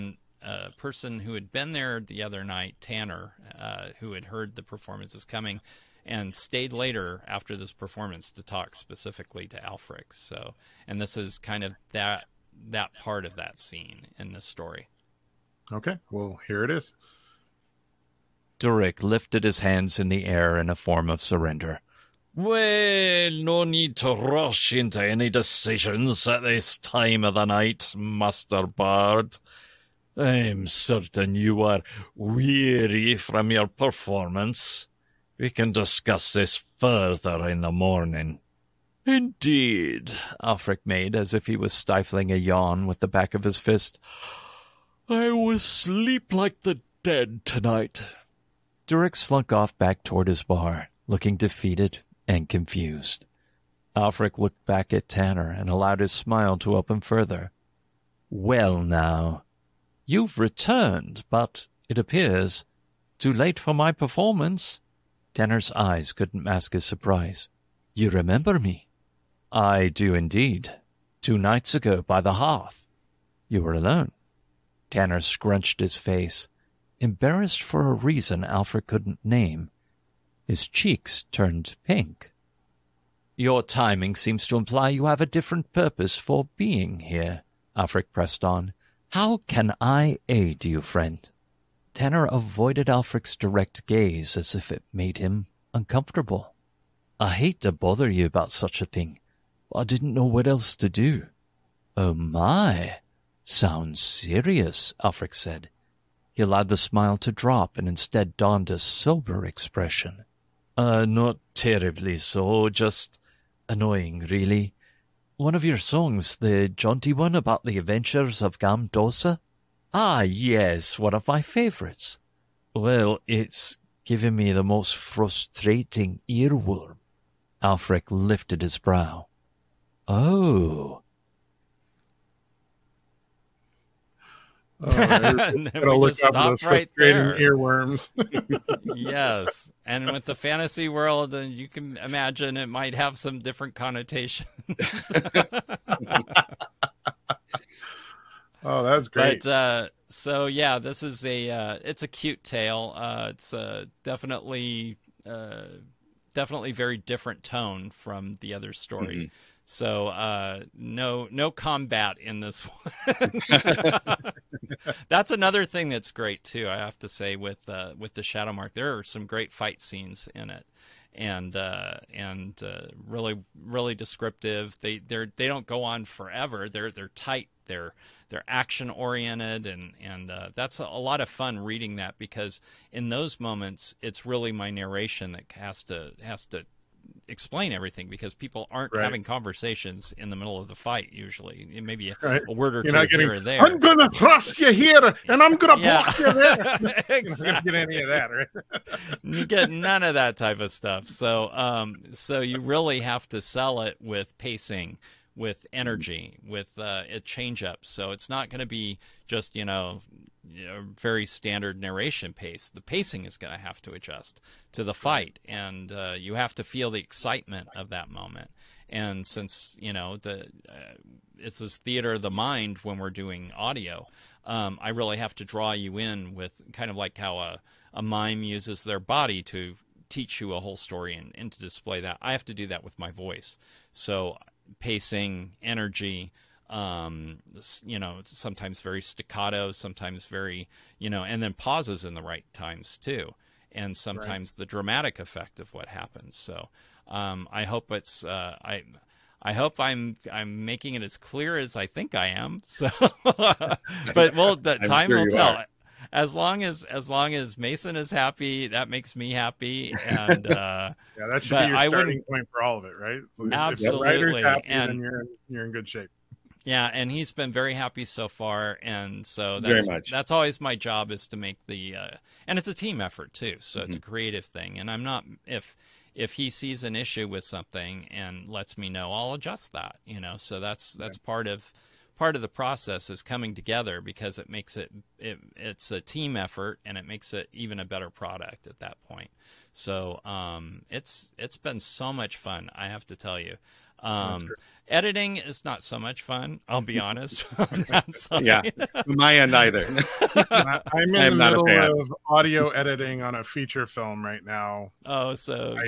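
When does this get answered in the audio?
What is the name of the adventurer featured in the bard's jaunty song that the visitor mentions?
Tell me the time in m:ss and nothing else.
1:58.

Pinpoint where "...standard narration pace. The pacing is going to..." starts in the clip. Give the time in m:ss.
3:31.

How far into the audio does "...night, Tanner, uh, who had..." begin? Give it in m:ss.
0:02.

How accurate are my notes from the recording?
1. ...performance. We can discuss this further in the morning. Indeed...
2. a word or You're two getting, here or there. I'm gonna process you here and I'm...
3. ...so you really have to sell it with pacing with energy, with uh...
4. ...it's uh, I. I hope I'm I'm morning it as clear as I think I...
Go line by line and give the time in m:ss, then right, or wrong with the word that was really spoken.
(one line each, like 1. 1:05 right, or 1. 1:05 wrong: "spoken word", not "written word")
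1. 0:33 right
2. 3:12 wrong: "cross", not "process"
3. 3:22 right
4. 4:07 wrong: "making", not "morning".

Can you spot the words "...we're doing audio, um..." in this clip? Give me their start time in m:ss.
3:42.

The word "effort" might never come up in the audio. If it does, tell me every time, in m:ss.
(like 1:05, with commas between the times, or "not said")
4:33, 4:46.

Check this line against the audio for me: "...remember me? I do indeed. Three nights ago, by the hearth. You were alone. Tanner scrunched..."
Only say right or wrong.
wrong.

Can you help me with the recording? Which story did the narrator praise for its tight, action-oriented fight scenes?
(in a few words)
The Shadow Mark.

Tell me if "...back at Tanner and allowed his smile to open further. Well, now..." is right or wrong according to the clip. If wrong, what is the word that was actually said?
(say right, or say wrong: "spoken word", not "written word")
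right.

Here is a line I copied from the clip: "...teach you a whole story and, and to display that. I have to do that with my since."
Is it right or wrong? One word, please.
wrong.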